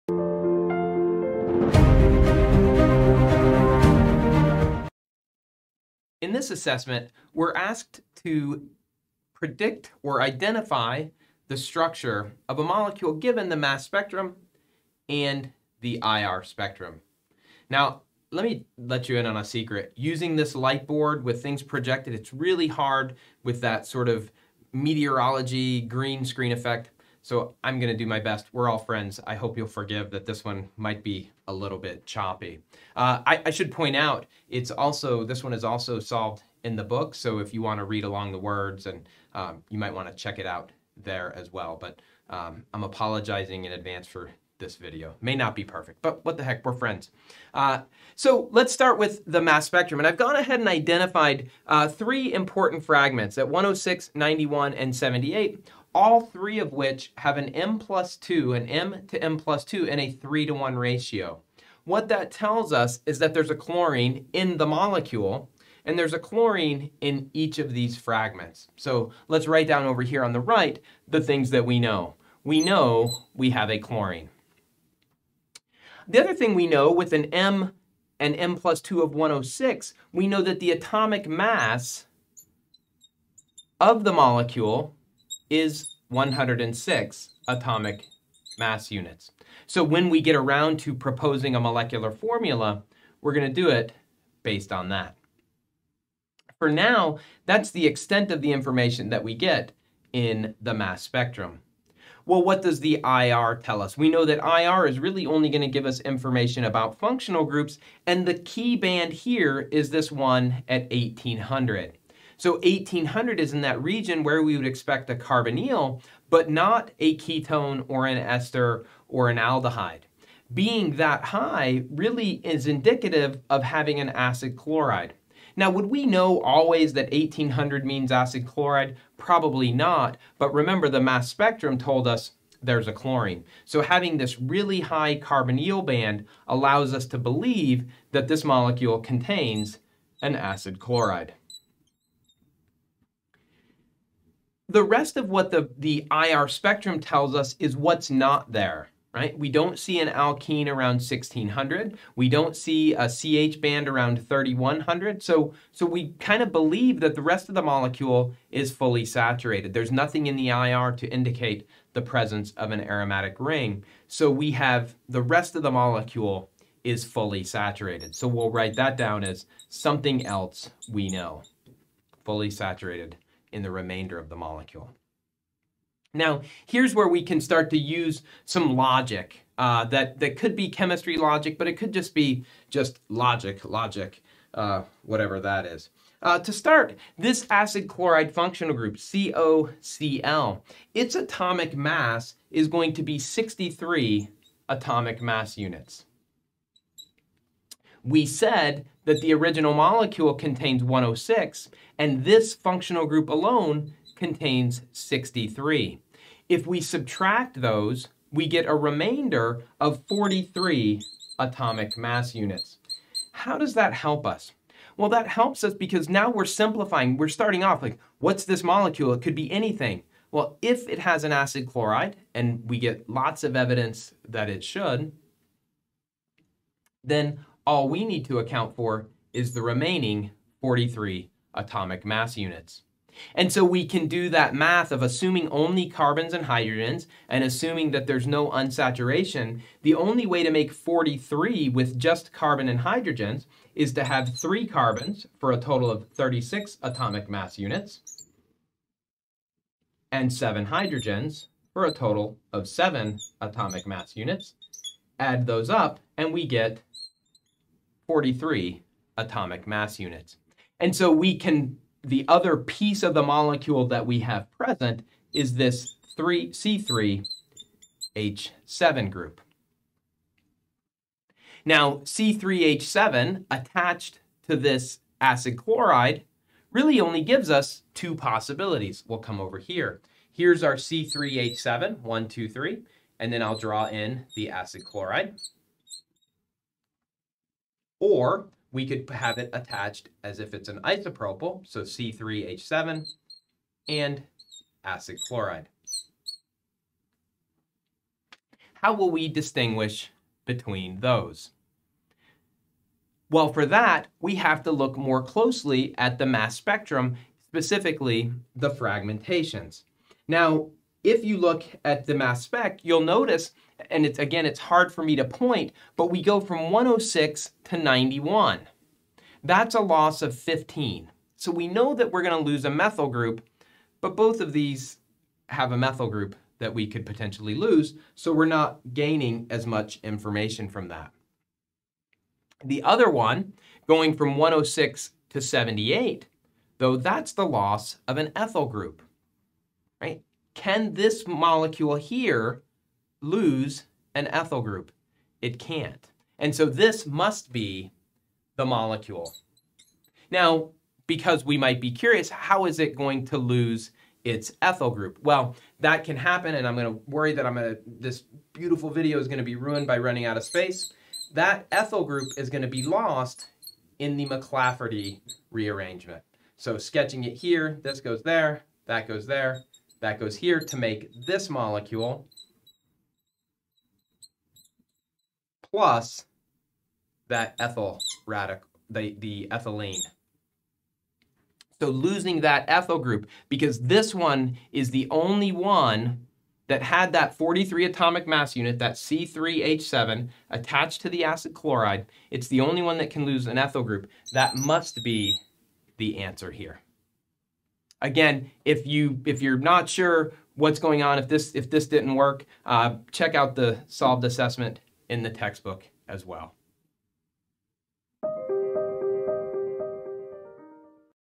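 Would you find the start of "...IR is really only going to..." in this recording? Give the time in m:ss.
1:44.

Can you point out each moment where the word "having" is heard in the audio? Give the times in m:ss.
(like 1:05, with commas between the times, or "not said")
2:03, 2:13.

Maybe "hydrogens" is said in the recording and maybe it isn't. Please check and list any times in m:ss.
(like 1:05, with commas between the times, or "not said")
3:56, 4:02, 4:10.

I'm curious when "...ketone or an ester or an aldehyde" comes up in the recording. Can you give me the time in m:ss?
1:57.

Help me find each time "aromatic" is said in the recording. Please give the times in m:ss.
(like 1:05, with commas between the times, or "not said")
2:42.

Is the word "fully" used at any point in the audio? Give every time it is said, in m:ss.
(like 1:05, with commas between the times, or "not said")
2:38, 2:47, 2:52.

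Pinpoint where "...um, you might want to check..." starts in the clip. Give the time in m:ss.
0:39.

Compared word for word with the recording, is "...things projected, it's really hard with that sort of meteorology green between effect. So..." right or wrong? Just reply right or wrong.
wrong.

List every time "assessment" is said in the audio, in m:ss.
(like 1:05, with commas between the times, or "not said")
0:06, 6:44.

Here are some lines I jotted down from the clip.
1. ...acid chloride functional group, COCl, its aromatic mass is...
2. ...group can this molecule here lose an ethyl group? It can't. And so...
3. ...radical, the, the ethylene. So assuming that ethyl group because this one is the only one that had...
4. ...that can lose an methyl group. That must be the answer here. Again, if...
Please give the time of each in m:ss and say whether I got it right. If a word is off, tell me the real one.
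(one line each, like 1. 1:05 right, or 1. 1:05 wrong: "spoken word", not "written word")
1. 3:07 wrong: "atomic", not "aromatic"
2. 5:38 right
3. 6:18 wrong: "losing", not "assuming"
4. 6:32 wrong: "ethyl", not "methyl".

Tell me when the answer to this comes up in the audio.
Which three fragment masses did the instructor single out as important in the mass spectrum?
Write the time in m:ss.
0:53.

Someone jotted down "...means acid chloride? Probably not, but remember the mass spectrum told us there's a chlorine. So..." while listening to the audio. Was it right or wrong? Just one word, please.
right.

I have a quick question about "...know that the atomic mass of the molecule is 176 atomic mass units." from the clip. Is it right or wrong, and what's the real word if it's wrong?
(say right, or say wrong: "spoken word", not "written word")
wrong: "106", not "176".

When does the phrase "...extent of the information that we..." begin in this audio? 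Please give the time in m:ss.
1:37.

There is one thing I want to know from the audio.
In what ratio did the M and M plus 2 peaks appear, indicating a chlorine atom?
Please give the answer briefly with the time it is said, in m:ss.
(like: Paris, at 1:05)
3 to 1, at 1:00.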